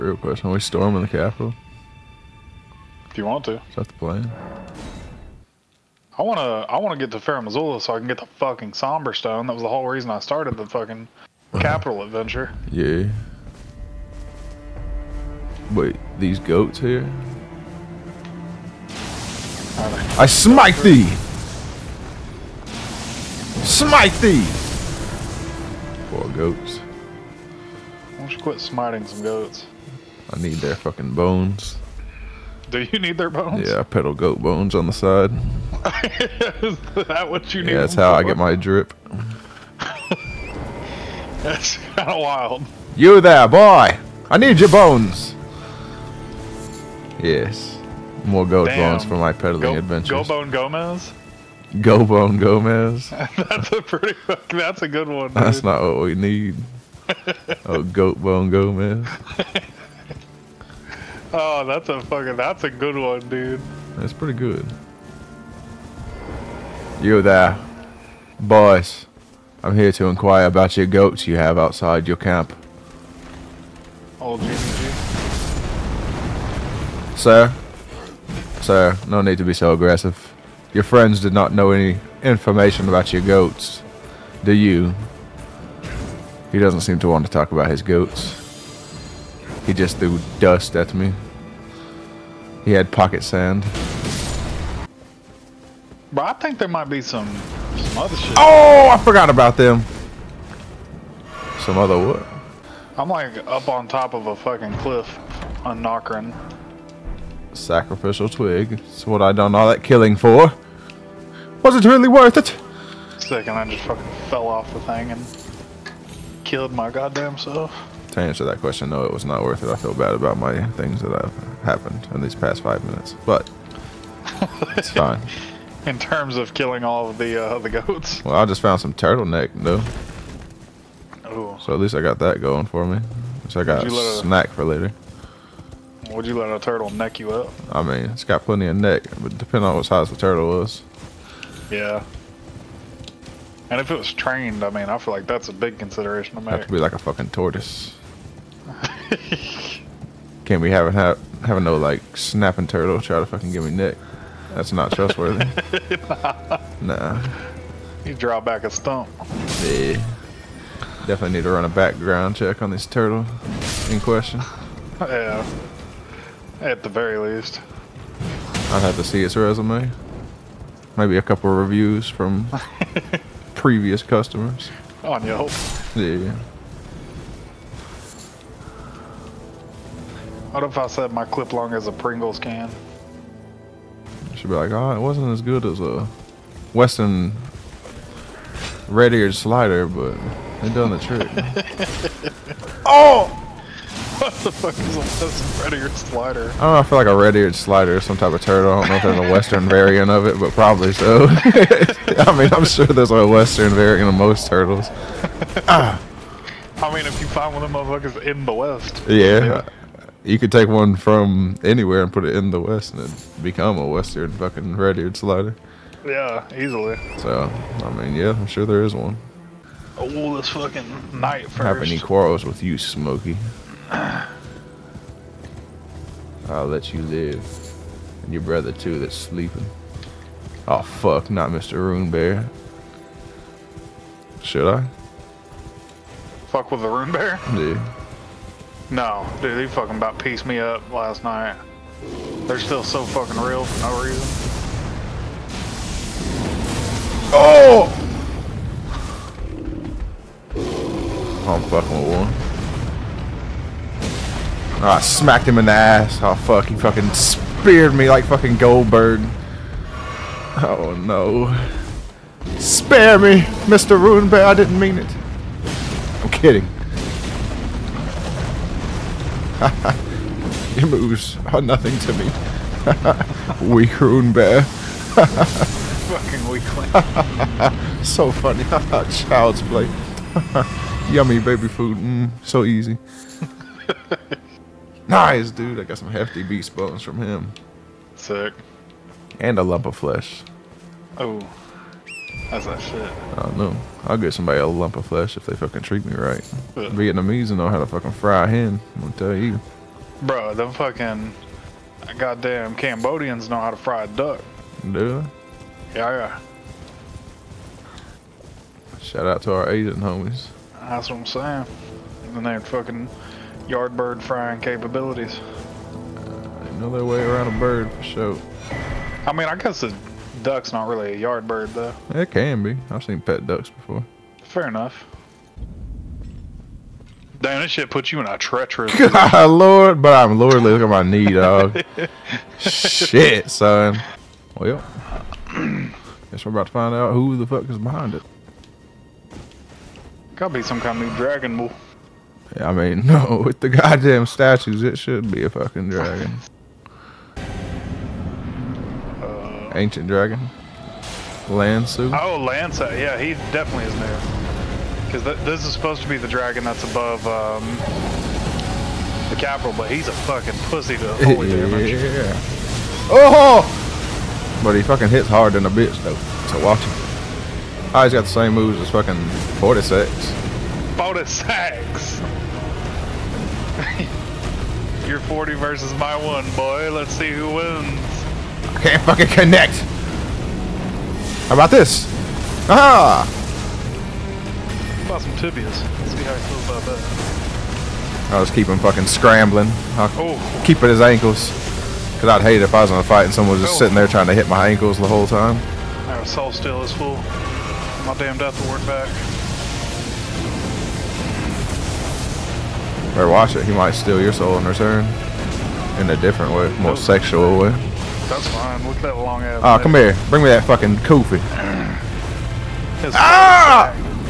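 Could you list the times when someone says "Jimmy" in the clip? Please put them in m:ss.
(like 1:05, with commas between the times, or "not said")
1:14.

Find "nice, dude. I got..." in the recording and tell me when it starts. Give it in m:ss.
4:45.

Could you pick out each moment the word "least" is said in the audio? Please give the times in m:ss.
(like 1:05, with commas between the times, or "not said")
2:11, 2:47.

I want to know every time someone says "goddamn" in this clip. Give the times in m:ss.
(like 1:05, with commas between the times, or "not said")
1:56, 5:02, 5:43.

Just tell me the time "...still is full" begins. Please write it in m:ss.
6:36.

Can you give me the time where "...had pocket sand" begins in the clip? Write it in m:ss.
1:32.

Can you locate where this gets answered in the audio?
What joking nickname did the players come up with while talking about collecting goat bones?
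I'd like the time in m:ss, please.
0:57.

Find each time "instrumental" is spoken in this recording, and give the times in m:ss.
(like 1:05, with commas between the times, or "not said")
not said.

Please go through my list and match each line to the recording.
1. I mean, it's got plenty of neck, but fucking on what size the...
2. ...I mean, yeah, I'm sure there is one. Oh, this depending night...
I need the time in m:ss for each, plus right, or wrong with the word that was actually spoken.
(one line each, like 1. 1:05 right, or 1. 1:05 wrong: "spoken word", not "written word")
1. 2:17 wrong: "depending", not "fucking"
2. 3:37 wrong: "fucking", not "depending".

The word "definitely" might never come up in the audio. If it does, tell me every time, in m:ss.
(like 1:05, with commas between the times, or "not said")
2:41, 5:53.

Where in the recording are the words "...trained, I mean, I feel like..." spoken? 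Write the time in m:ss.
2:24.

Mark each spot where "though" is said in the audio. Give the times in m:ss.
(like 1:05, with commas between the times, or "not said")
5:21, 6:06.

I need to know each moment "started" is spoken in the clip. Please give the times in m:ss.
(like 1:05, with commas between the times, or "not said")
0:10.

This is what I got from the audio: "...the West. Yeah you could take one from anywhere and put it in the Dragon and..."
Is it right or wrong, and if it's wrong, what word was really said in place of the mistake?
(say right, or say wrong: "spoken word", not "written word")
wrong: "West", not "Dragon".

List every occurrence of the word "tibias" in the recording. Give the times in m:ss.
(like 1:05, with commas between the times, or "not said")
6:25.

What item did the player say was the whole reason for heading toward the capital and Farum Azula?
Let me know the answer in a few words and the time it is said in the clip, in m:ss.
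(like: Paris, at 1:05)
Somber Stone, at 0:08.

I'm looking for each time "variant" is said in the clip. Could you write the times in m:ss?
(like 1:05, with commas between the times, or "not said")
3:19, 3:23.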